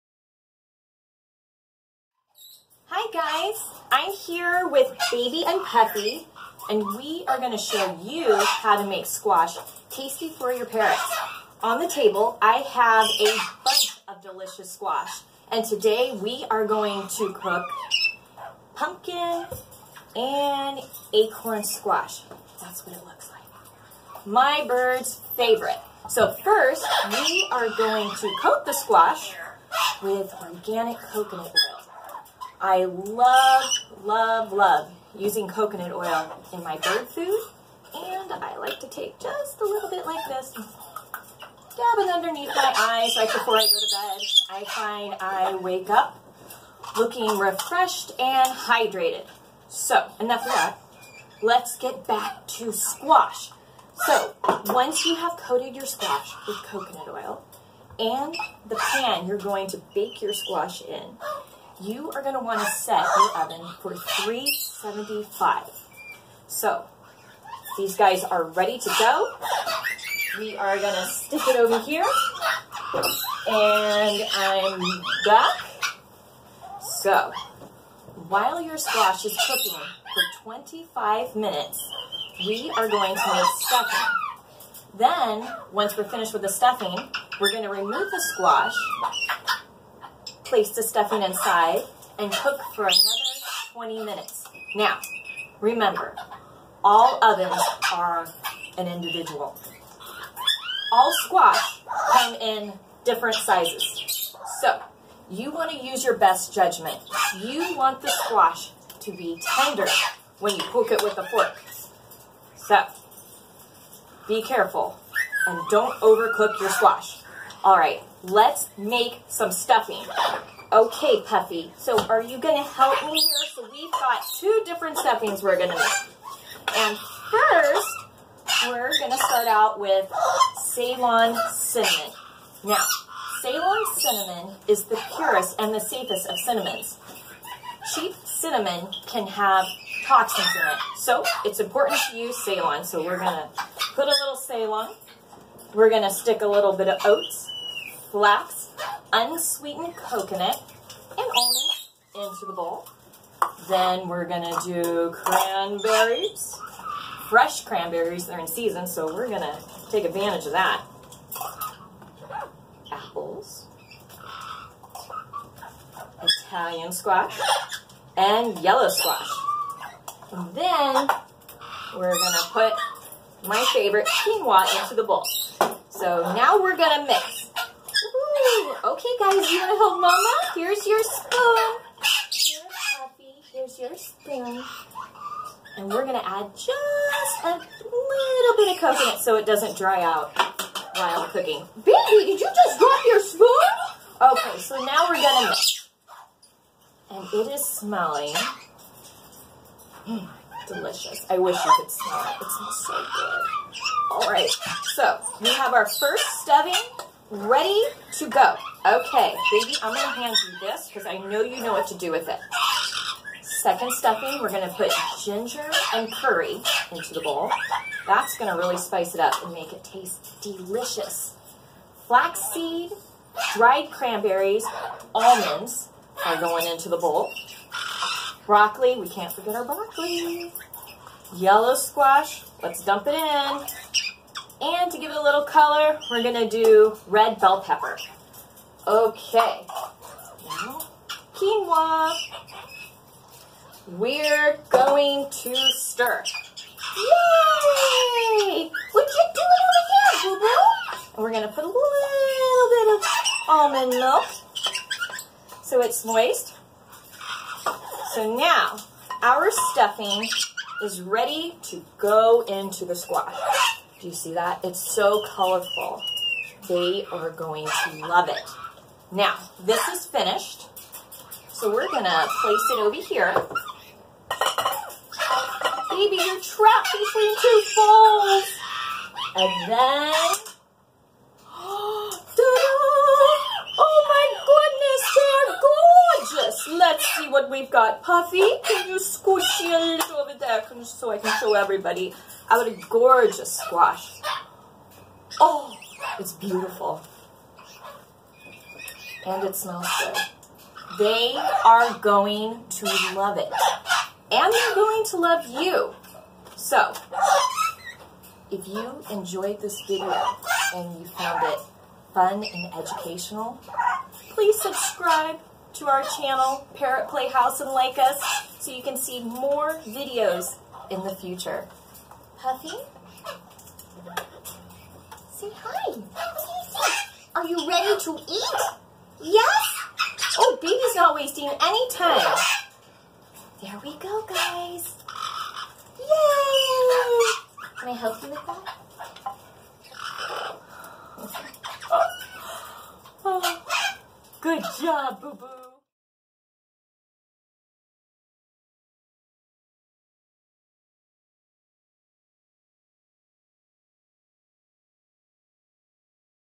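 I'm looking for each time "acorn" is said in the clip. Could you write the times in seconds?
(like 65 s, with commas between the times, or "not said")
21 s.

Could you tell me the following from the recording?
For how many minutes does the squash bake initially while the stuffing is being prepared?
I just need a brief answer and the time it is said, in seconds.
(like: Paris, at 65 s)
25, at 80 s.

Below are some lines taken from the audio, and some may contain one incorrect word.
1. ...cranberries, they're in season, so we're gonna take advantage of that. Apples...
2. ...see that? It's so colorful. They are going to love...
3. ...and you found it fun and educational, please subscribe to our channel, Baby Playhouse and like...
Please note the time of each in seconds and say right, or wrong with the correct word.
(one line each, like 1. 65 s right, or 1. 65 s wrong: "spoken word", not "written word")
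1. 157 s right
2. 264 s right
3. 310 s wrong: "Parrot", not "Baby".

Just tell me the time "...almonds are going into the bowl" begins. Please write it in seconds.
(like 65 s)
225 s.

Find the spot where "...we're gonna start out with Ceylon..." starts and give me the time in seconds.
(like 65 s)
128 s.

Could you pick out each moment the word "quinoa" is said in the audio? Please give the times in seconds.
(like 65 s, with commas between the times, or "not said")
174 s, 241 s.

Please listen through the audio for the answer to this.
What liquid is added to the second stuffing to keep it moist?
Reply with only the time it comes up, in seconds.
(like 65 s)
253 s.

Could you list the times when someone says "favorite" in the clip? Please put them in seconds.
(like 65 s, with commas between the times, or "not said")
25 s, 173 s.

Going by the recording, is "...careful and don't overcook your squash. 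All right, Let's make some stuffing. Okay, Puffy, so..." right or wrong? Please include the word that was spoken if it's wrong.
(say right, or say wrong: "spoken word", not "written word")
right.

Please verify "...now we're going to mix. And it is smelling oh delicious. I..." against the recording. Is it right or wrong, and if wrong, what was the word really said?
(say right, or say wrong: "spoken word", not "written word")
right.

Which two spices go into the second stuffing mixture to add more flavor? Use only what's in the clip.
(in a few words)
ginger and curry.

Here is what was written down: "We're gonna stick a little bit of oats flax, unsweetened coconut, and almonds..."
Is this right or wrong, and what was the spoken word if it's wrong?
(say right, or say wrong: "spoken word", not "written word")
right.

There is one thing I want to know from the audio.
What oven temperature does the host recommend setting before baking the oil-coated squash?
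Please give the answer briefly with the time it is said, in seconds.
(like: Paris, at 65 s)
375, at 63 s.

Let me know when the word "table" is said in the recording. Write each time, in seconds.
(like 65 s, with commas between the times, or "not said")
11 s.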